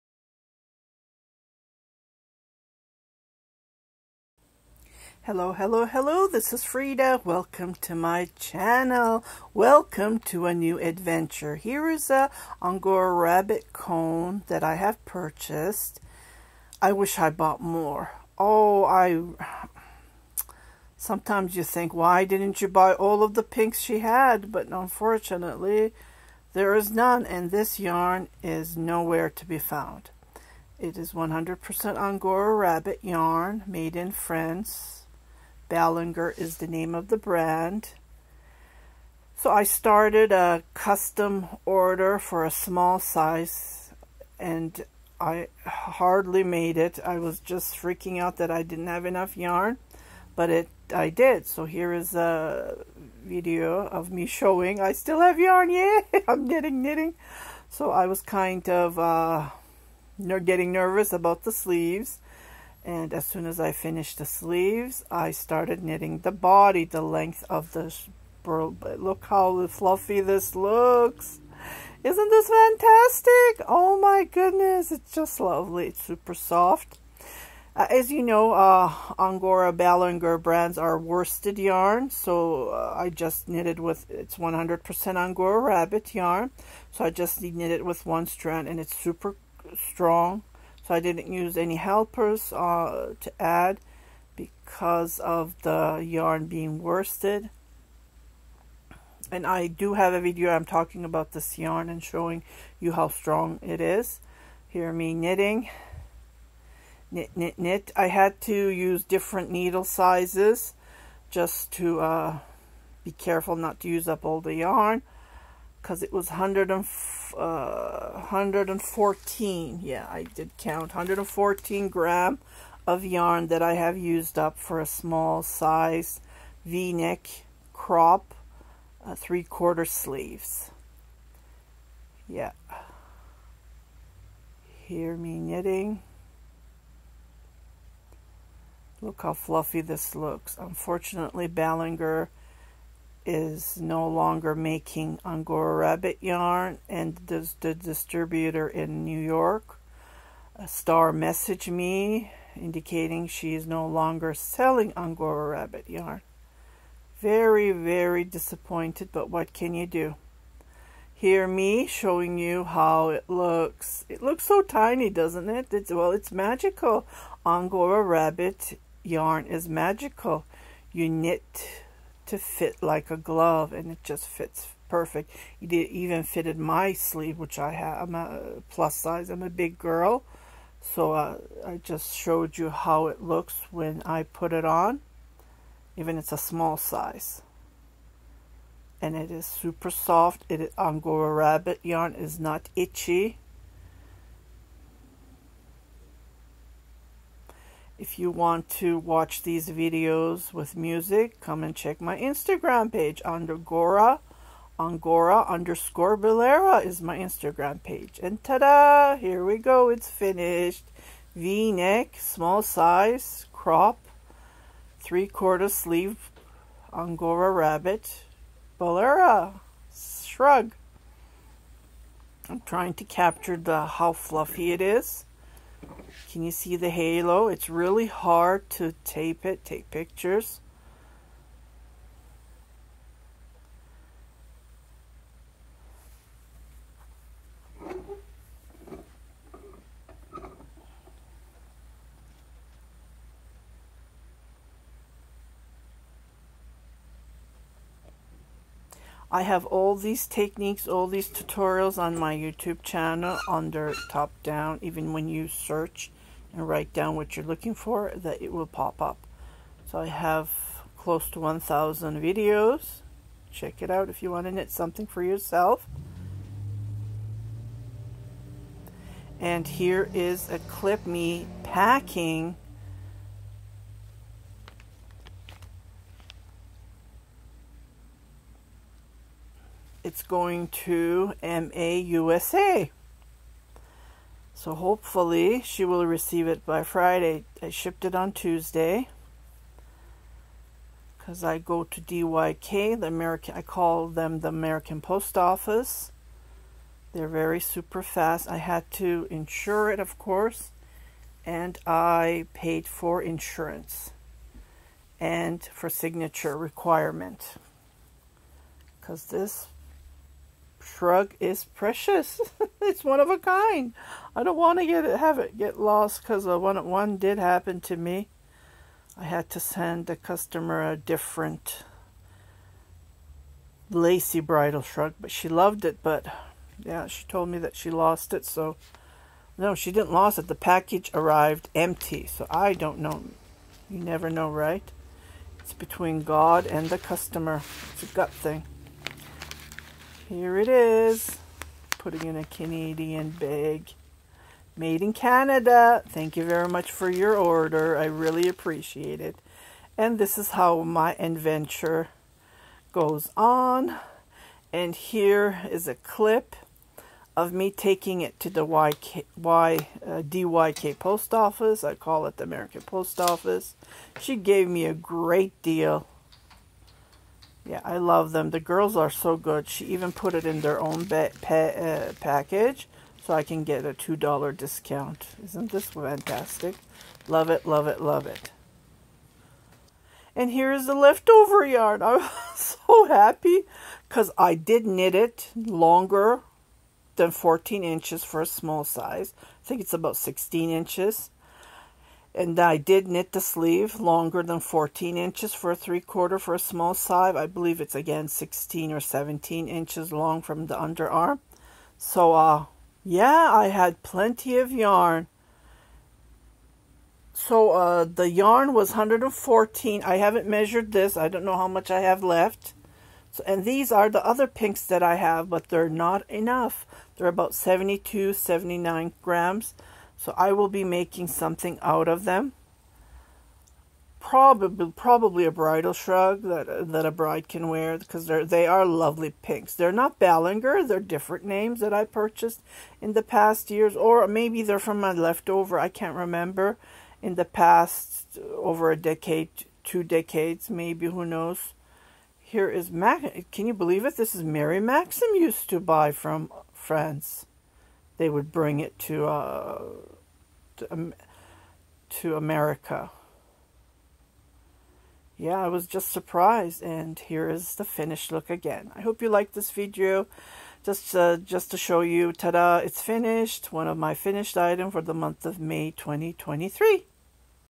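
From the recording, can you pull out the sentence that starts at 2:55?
It even fitted my sleeve, which I have.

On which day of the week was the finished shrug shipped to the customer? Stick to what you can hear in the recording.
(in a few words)
Tuesday.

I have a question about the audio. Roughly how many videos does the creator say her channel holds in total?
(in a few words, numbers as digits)
1,000.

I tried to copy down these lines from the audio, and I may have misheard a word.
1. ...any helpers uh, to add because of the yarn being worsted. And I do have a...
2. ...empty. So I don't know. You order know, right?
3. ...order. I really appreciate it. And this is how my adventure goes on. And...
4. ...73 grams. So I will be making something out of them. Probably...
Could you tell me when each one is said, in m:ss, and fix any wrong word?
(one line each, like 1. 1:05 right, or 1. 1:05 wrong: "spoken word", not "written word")
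1. 1:31 right
2. 5:31 wrong: "never", not "order"
3. 5:47 right
4. 6:58 wrong: "79", not "73".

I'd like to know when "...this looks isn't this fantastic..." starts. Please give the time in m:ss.
1:10.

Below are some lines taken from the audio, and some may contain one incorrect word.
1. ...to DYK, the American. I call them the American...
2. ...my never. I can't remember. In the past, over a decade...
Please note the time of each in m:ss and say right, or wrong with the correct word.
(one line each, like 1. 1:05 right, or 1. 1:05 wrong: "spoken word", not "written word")
1. 4:51 right
2. 7:14 wrong: "leftover", not "never".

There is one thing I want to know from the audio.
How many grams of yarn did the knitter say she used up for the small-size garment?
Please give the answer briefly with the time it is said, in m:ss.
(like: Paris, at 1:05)
114, at 2:00.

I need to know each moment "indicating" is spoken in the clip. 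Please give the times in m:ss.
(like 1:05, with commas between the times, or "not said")
2:32.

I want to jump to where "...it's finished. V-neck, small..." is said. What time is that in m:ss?
3:29.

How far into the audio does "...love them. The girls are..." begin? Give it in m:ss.
6:07.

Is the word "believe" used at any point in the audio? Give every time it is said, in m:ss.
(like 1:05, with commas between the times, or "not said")
6:37, 7:23.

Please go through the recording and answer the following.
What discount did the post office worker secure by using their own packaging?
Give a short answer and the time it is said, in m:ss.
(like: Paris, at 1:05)
$2, at 6:13.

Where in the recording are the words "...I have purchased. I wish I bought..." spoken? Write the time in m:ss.
0:14.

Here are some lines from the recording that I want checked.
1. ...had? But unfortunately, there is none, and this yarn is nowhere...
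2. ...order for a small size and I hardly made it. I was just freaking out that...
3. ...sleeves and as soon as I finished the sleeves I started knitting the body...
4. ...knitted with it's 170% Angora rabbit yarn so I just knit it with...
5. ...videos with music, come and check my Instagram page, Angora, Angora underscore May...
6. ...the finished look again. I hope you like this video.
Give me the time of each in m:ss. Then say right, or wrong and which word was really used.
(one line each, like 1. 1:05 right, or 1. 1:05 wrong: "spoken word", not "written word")
1. 0:23 right
2. 0:41 right
3. 1:01 right
4. 1:23 wrong: "100", not "170"
5. 3:19 wrong: "Bolero", not "May"
6. 7:37 right.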